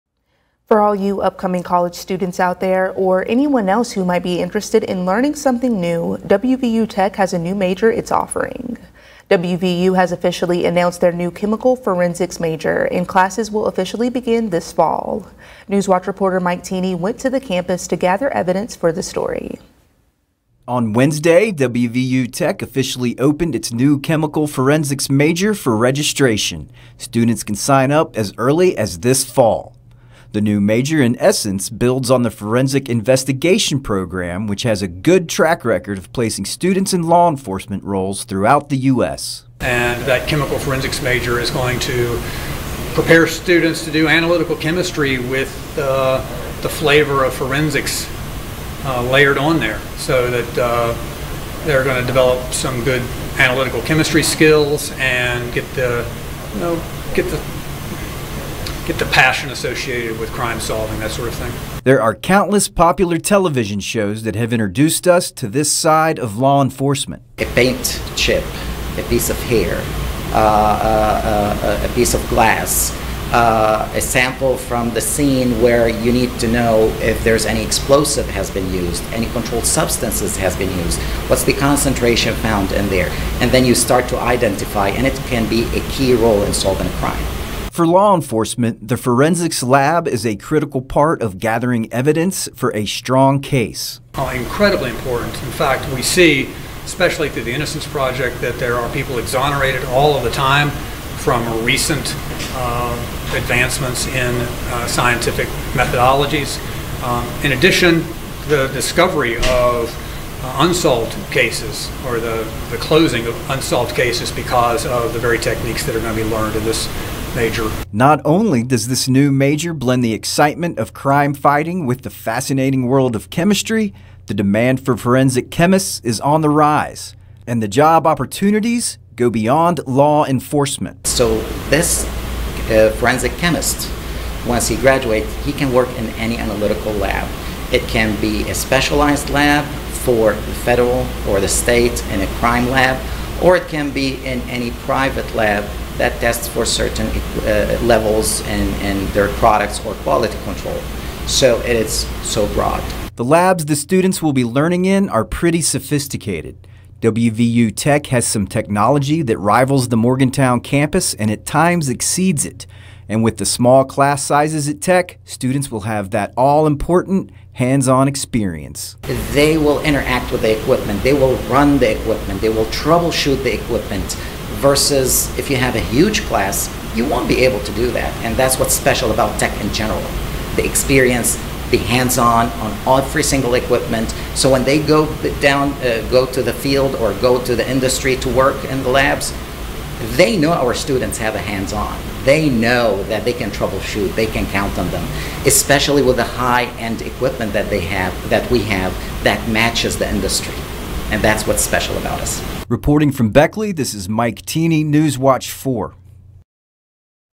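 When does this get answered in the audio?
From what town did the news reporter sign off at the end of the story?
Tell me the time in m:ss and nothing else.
3:23.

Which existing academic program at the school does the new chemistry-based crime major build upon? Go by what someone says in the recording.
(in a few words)
Forensic Investigation Program.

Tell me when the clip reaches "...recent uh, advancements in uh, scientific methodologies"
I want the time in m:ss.
1:41.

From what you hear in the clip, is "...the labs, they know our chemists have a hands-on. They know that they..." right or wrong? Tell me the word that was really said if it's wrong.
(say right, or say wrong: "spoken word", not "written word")
wrong: "students", not "chemists".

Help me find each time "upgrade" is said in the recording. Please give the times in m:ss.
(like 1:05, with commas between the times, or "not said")
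not said.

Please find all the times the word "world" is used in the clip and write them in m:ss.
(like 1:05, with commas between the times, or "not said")
2:02.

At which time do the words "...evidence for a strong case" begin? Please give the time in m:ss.
1:31.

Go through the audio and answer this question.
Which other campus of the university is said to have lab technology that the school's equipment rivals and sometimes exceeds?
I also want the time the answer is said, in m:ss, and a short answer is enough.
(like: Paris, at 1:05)
Morgantown, at 2:39.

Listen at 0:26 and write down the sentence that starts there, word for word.
Students can sign up as early as this fall.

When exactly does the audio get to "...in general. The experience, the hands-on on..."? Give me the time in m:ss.
2:59.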